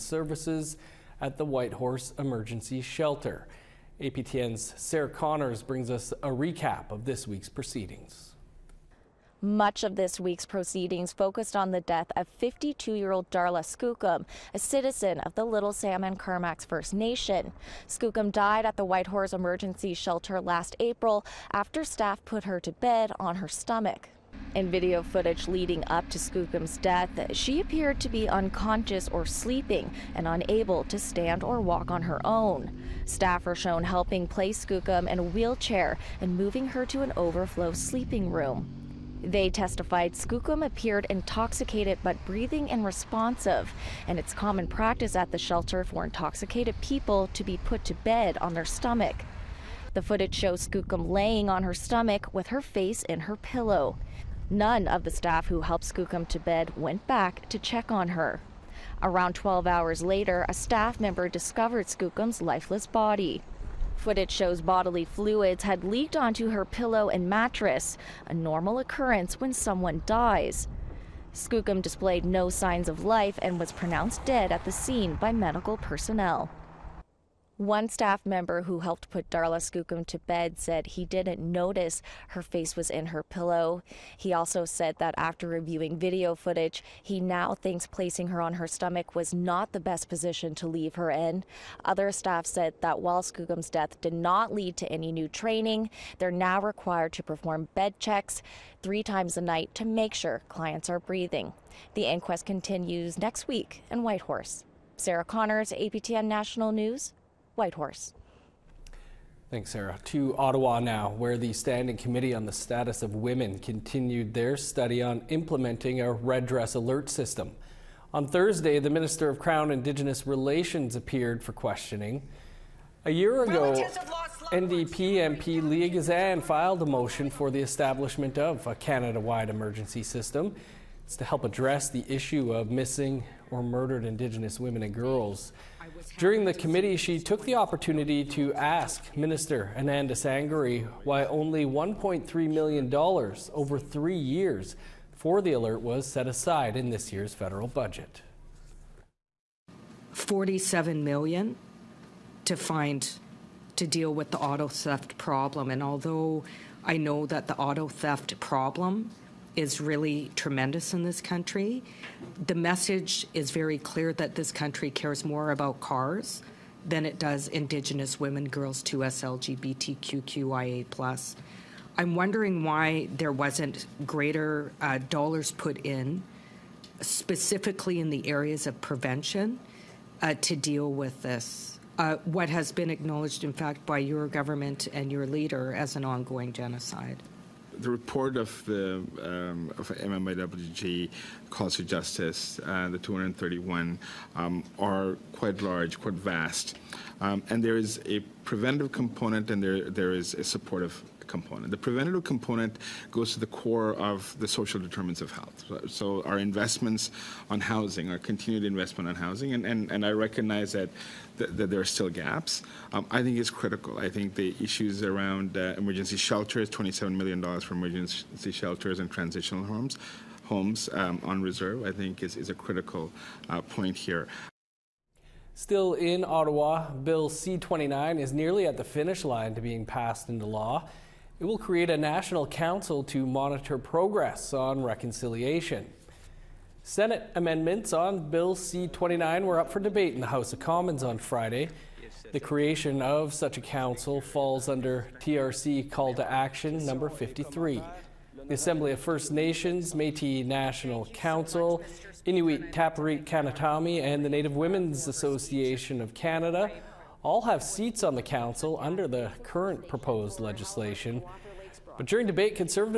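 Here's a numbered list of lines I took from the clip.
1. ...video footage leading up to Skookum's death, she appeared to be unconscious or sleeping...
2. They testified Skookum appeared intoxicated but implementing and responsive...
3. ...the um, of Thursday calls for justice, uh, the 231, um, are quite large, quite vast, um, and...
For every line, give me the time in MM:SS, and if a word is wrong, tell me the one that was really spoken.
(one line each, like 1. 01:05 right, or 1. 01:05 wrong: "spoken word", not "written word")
1. 00:24 right
2. 00:39 wrong: "breathing", not "implementing"
3. 03:08 wrong: "MMIWG", not "Thursday".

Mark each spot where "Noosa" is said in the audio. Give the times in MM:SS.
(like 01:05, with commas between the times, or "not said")
not said.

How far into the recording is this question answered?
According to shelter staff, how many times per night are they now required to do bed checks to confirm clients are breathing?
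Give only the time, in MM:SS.
01:38.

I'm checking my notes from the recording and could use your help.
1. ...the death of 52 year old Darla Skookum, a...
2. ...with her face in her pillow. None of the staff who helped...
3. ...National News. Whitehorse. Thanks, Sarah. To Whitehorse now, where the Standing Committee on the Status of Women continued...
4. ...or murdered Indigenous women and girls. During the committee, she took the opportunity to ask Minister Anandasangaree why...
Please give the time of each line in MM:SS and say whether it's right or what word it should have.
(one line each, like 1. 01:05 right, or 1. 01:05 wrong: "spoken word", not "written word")
1. 00:11 right
2. 00:52 right
3. 01:46 wrong: "Ottawa", not "Whitehorse"
4. 02:13 right.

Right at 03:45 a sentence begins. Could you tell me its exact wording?
Still in Ottawa, Bill C 29 is nearly at the finish line to being passed into law.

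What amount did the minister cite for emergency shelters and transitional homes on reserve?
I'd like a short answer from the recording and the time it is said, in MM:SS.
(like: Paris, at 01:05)
$27 million, at 03:36.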